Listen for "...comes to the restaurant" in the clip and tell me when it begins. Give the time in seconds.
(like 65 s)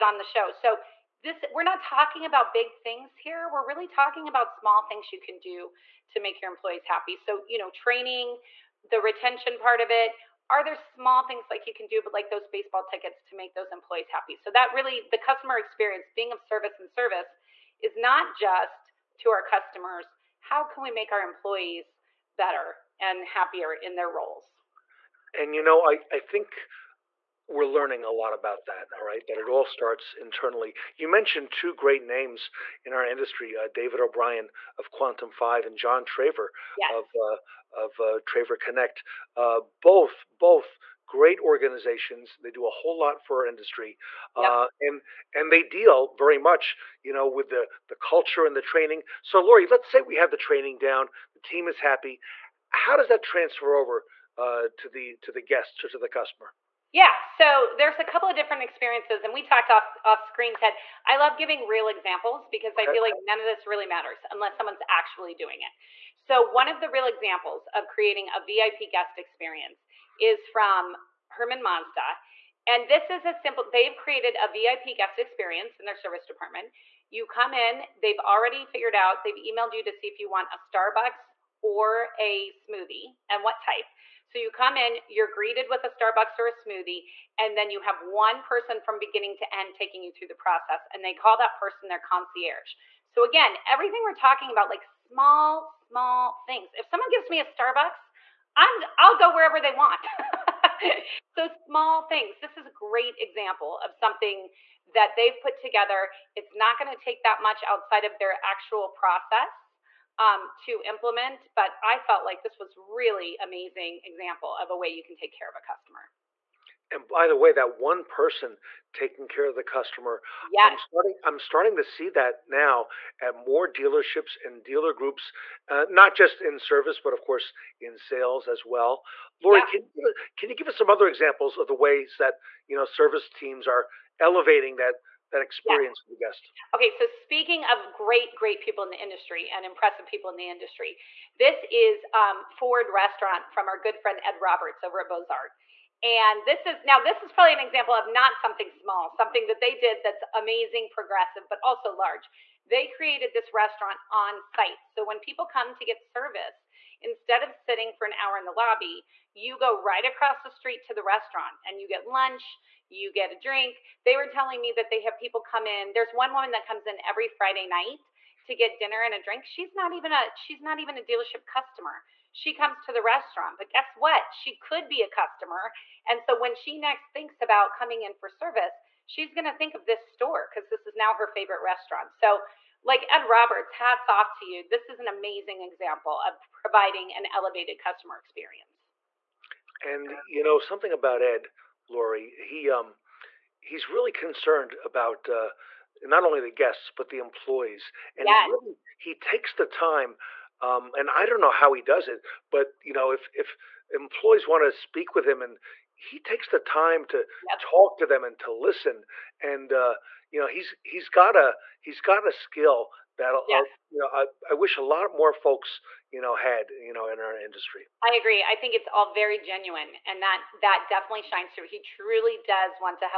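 172 s.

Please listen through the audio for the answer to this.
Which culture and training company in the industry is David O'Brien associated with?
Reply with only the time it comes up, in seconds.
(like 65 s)
34 s.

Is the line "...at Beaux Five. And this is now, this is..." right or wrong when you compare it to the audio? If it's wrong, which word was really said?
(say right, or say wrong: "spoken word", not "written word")
wrong: "Arts", not "Five".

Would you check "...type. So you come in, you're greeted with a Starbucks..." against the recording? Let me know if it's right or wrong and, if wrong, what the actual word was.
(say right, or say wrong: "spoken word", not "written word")
right.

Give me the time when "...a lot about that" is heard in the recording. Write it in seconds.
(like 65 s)
28 s.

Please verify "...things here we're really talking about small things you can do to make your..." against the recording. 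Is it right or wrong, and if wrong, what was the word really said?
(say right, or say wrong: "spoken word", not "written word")
right.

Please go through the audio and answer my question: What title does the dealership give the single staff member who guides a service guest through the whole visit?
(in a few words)
concierge.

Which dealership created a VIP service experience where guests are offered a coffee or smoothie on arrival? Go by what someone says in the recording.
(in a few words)
Herman Mazda.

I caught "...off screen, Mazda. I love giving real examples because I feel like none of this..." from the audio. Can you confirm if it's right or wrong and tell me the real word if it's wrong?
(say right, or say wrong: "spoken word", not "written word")
wrong: "Ted", not "Mazda".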